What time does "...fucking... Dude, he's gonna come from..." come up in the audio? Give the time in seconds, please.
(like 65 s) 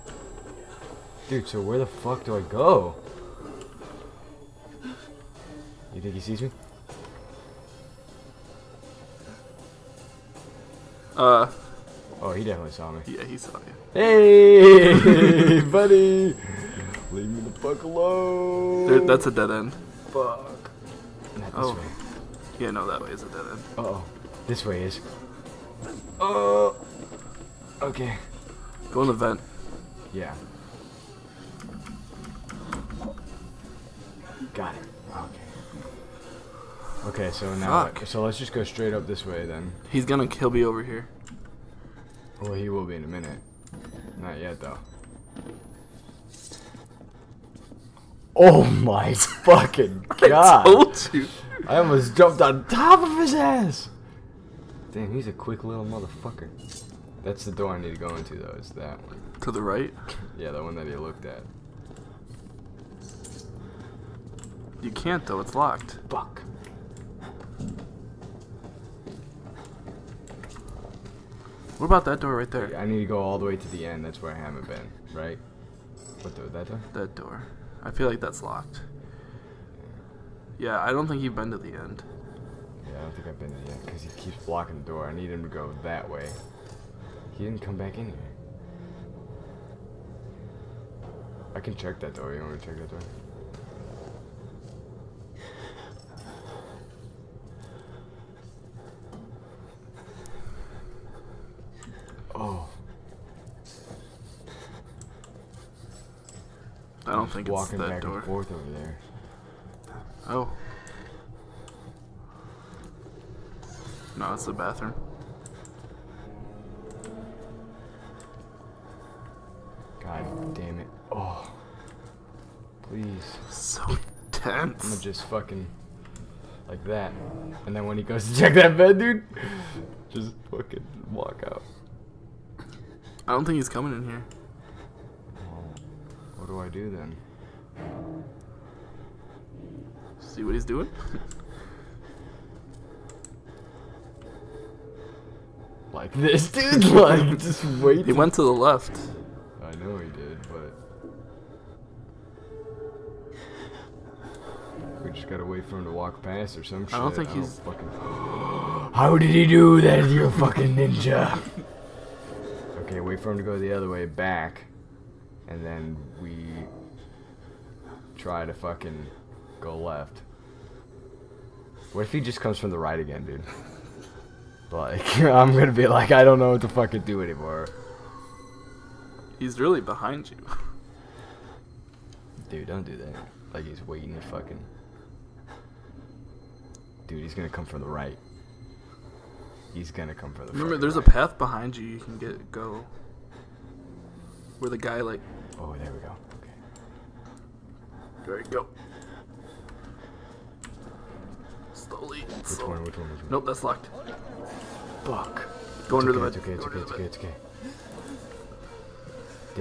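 184 s.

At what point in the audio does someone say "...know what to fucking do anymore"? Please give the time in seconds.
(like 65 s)
176 s.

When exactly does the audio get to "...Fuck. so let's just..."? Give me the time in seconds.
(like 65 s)
37 s.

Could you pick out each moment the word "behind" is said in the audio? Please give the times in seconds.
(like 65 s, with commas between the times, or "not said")
179 s, 191 s.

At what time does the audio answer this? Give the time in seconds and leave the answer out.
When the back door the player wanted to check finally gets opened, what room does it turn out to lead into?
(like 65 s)
114 s.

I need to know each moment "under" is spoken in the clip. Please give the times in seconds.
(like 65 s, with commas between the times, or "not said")
205 s.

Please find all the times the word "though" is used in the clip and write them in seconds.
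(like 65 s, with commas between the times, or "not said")
44 s, 58 s, 65 s.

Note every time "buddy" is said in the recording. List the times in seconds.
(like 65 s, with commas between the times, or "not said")
15 s.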